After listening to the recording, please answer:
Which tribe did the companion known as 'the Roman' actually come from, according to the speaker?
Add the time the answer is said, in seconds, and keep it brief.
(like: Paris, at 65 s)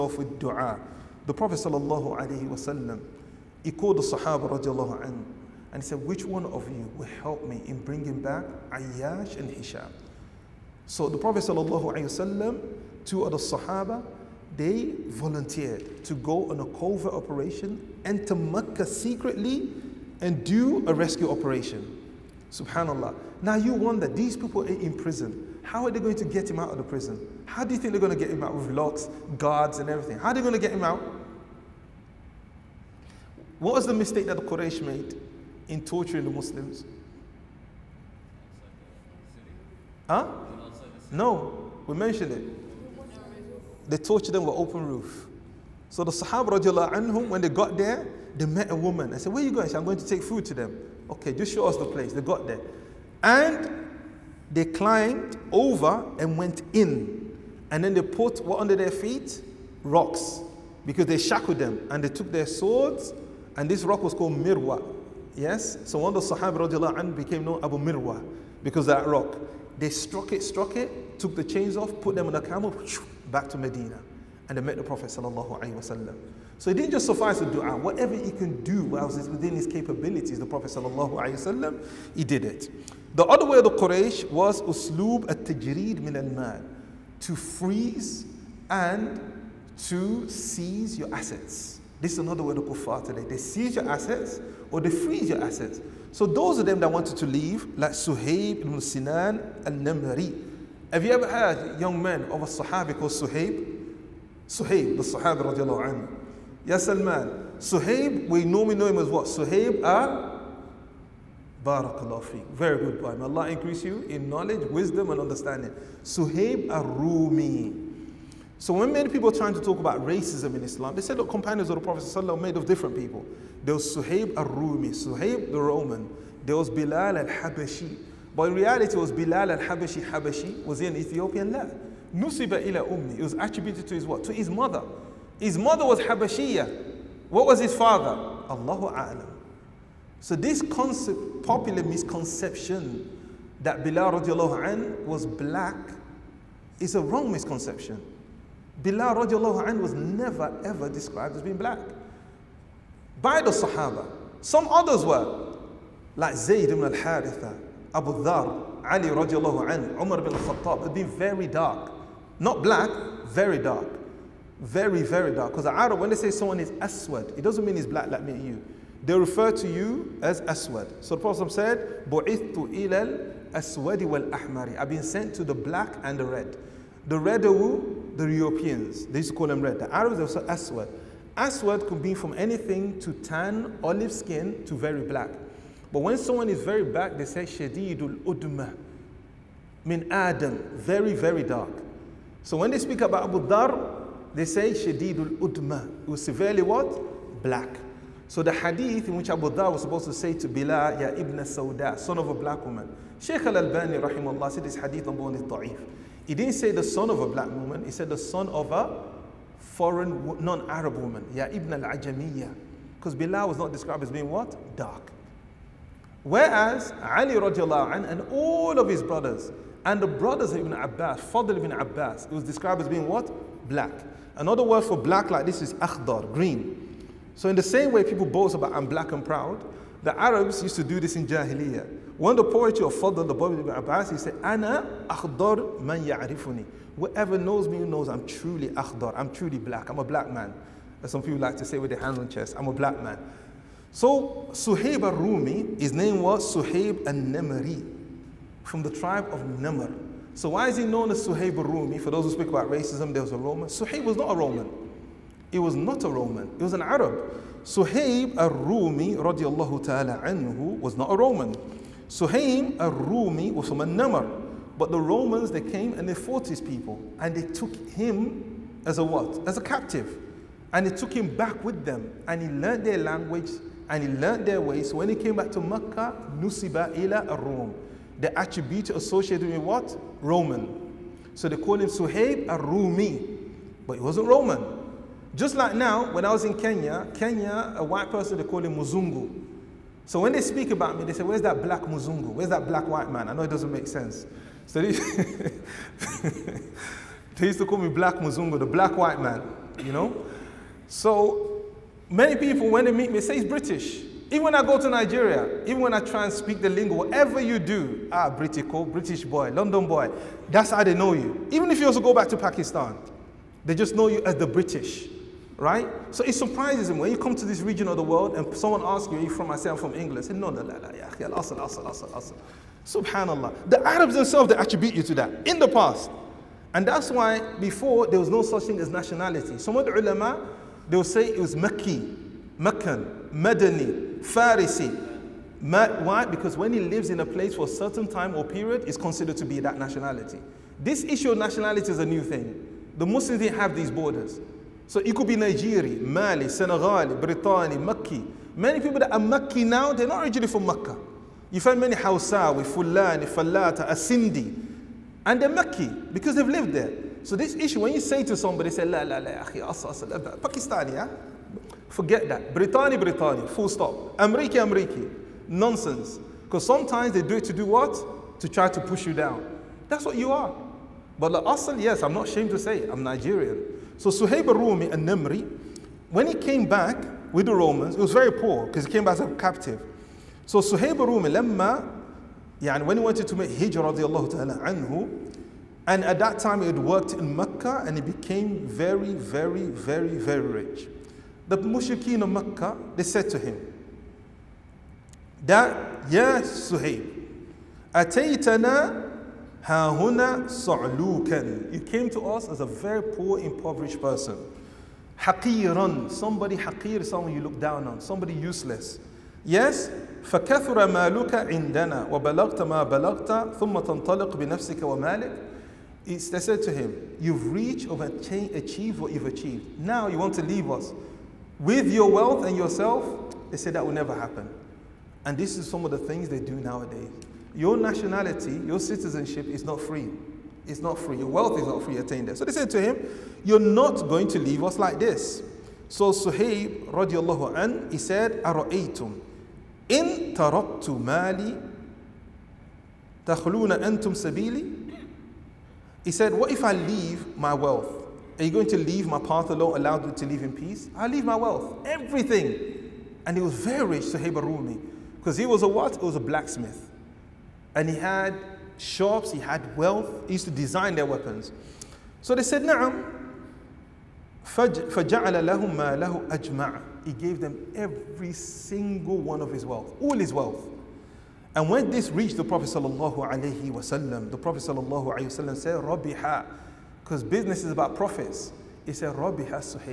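Namr, at 249 s.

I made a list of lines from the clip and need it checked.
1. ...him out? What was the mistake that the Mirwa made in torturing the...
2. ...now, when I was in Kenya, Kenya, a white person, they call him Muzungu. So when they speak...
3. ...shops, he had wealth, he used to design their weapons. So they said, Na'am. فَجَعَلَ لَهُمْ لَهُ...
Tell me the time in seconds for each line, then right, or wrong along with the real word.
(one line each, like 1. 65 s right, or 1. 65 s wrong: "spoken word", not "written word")
1. 30 s wrong: "Quraysh", not "Mirwa"
2. 285 s right
3. 458 s right.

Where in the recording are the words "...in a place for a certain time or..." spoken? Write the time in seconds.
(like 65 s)
337 s.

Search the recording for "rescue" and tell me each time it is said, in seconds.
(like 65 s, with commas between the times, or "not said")
20 s.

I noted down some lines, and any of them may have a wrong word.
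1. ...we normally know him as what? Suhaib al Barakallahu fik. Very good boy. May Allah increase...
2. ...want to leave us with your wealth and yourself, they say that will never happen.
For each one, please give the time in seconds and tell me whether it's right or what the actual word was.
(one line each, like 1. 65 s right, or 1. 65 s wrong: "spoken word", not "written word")
1. 108 s right
2. 420 s right.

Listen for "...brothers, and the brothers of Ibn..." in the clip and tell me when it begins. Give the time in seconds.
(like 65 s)
219 s.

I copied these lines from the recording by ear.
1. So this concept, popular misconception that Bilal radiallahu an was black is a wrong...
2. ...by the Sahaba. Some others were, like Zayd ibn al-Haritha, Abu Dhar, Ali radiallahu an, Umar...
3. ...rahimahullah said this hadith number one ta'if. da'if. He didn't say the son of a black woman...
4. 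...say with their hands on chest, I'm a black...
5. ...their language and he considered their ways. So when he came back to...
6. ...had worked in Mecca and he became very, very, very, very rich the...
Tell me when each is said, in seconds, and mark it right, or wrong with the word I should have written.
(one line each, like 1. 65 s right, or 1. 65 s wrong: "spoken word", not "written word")
1. 140 s right
2. 153 s right
3. 203 s right
4. 241 s right
5. 272 s wrong: "learned", not "considered"
6. 386 s right.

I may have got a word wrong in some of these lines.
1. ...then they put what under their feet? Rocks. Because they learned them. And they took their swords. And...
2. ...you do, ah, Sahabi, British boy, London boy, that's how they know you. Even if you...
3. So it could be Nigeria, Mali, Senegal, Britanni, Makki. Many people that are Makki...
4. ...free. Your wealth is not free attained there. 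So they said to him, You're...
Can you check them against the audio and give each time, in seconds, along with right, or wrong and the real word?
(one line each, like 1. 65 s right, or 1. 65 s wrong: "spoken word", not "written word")
1. 57 s wrong: "shackled", not "learned"
2. 307 s wrong: "Britico", not "Sahabi"
3. 344 s right
4. 430 s right.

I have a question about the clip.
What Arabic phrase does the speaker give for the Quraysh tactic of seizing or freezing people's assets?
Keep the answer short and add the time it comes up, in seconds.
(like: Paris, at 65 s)
uslub at-tajreed min al-mal, at 84 s.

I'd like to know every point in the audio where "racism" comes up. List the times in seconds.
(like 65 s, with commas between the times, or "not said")
120 s, 252 s.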